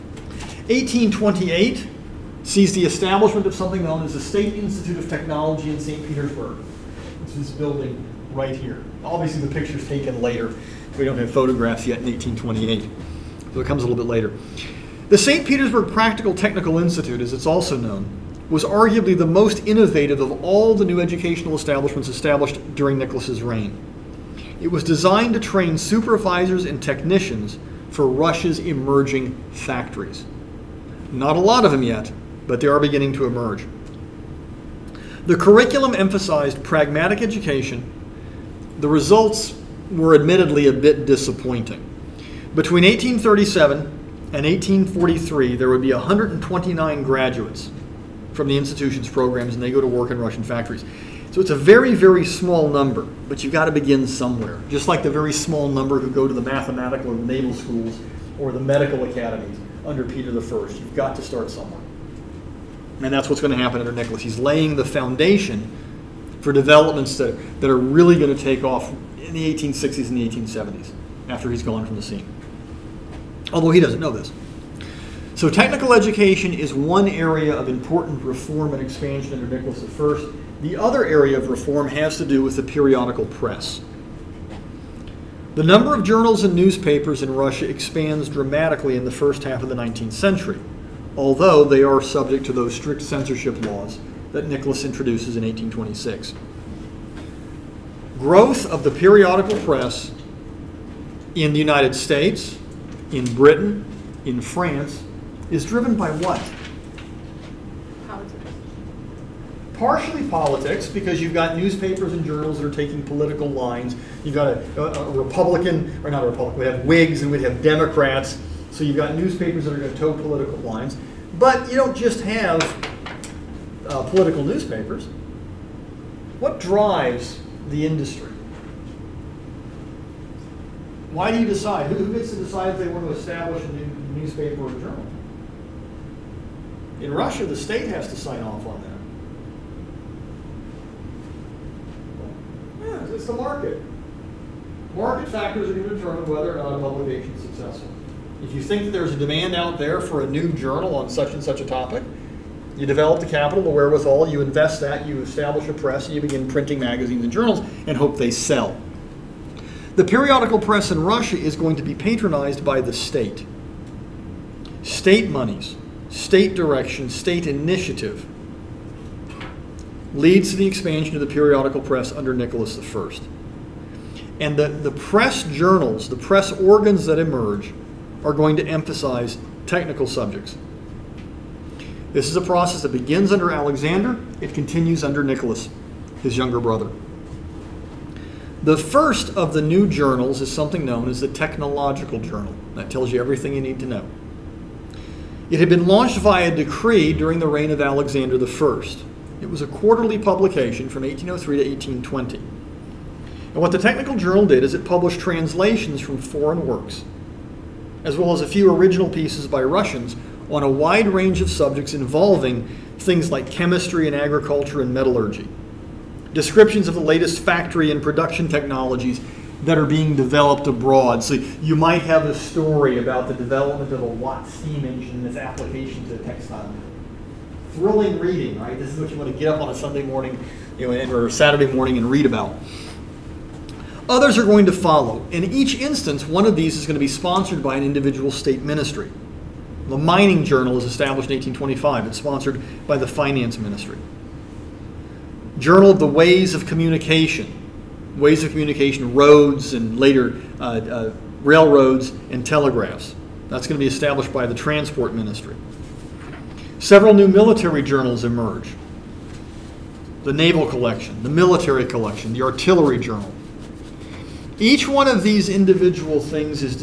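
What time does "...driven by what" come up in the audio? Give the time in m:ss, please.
1:45.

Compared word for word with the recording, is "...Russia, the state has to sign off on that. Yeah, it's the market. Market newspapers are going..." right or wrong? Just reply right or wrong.
wrong.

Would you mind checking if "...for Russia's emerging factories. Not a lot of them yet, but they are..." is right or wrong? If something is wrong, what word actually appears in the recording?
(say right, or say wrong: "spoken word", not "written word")
right.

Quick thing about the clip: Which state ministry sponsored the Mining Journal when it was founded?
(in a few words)
Finance Ministry.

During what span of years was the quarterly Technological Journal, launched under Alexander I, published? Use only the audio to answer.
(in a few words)
1803 to 1820.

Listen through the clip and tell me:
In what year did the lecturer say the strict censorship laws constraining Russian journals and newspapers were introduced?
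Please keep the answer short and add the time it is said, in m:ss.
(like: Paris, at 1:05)
1826, at 1:35.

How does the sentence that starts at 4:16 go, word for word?
Several new military journals emerge the naval collection, the military collection, the artillery journal.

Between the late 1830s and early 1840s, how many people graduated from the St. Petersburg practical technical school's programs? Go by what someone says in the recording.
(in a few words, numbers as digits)
129.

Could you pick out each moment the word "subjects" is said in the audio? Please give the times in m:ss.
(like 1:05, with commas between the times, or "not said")
1:32, 3:00, 3:31.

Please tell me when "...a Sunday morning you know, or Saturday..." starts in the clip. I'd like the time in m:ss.
3:49.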